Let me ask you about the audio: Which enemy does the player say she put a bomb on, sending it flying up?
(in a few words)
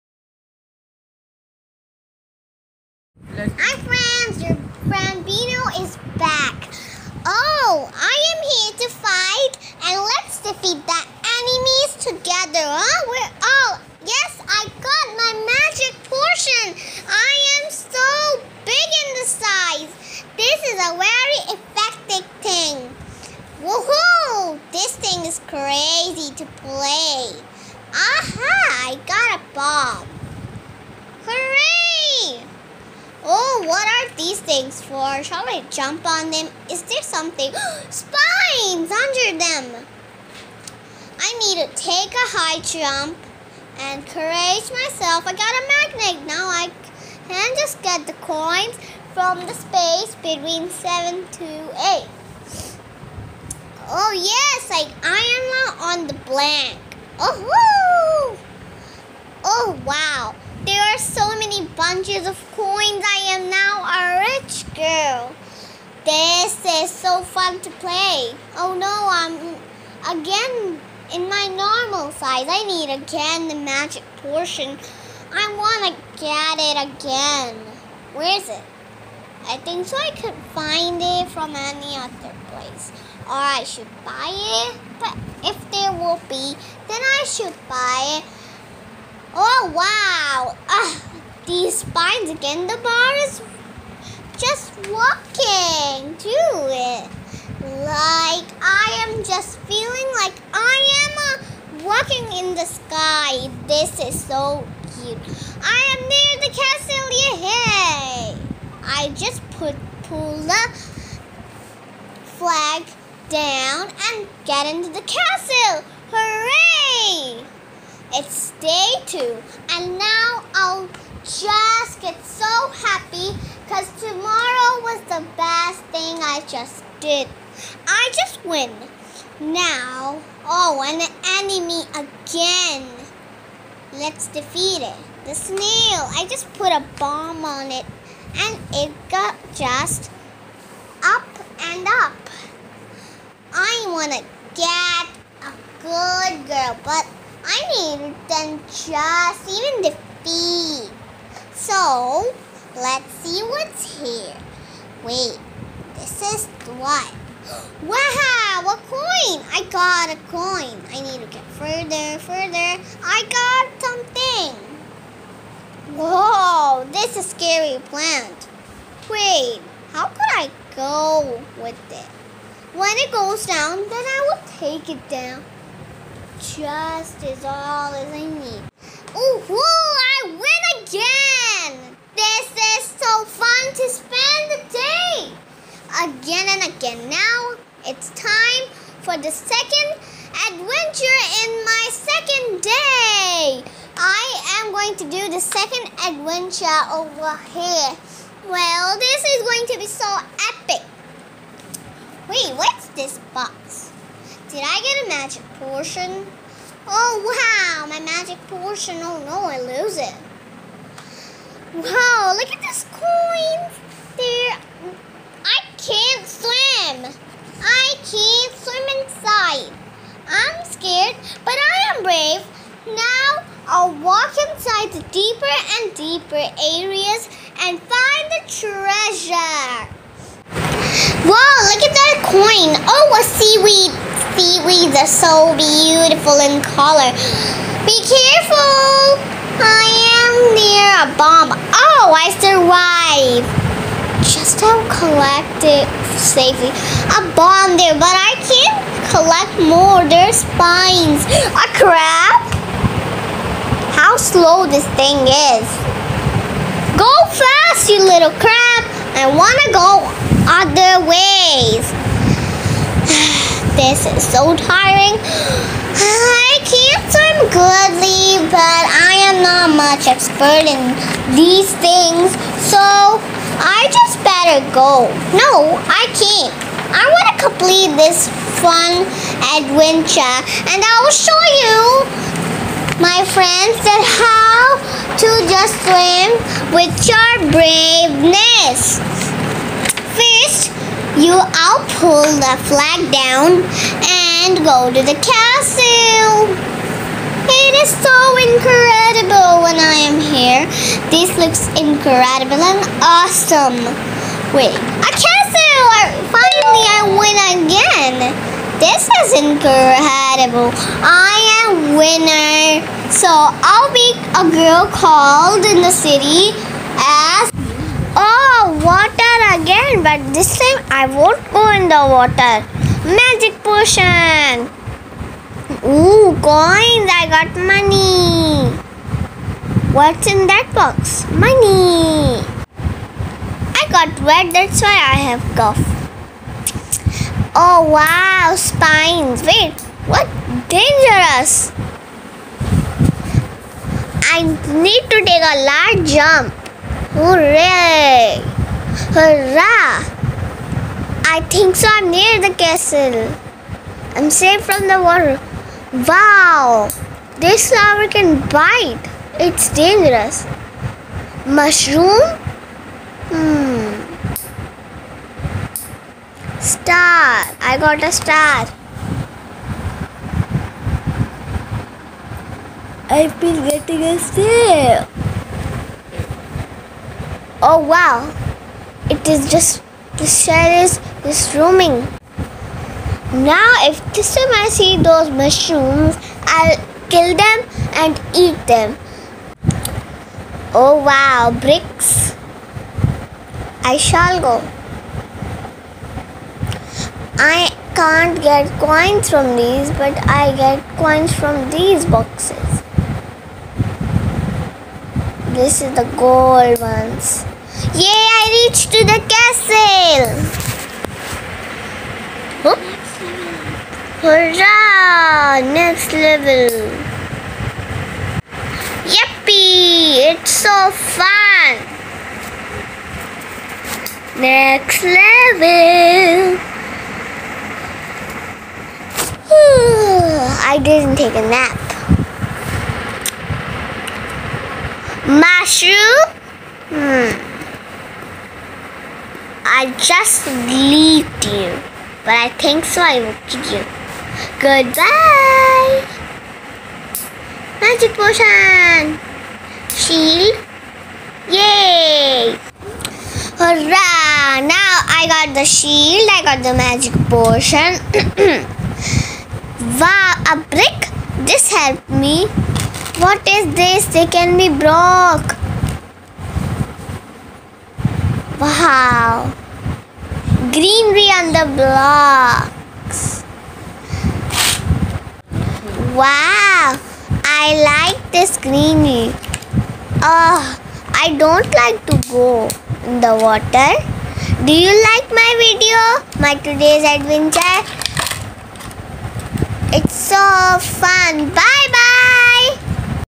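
The snail.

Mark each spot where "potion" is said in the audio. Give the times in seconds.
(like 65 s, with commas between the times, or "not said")
323 s, 448 s, 457 s.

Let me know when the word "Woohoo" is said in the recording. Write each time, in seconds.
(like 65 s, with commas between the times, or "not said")
23 s.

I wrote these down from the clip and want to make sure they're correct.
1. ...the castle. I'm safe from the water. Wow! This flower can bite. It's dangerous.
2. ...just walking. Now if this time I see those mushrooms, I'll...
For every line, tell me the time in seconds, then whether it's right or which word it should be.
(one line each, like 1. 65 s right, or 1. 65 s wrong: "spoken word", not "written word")
1. 352 s right
2. 381 s wrong: "roaming", not "walking".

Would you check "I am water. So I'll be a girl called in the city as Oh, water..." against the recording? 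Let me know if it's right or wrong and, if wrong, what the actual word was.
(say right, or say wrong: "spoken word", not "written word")
wrong: "winner", not "water".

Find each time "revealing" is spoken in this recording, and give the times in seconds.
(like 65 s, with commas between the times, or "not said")
not said.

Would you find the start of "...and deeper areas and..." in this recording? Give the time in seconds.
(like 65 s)
225 s.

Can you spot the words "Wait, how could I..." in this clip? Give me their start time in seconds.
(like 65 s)
169 s.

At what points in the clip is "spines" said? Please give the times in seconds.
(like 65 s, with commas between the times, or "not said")
37 s, 91 s, 250 s, 338 s.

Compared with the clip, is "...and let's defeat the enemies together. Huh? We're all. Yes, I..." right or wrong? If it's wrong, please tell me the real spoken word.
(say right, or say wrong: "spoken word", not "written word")
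right.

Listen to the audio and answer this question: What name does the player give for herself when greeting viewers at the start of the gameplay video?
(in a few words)
Bino.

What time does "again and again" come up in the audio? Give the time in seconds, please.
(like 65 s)
186 s.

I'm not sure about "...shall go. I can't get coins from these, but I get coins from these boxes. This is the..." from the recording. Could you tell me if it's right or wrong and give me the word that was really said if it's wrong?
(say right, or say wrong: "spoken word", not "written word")
right.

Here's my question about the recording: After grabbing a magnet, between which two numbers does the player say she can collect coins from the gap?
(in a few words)
7 to 8.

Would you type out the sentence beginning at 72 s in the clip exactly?
I need again the magic portion.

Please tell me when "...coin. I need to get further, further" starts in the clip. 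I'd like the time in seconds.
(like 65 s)
160 s.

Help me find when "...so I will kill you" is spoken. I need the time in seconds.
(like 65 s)
442 s.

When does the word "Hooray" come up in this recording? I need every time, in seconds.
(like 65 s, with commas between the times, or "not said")
116 s, 347 s.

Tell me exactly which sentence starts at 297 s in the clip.
It is so incredible when I am here.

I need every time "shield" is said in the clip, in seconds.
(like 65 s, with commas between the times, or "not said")
449 s, 455 s.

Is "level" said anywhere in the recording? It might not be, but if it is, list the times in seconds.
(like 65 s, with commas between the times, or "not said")
416 s, 425 s.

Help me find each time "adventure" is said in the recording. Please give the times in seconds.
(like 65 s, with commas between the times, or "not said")
190 s, 196 s, 279 s, 487 s.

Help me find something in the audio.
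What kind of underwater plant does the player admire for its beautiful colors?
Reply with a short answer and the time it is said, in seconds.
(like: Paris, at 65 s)
Seaweed, at 233 s.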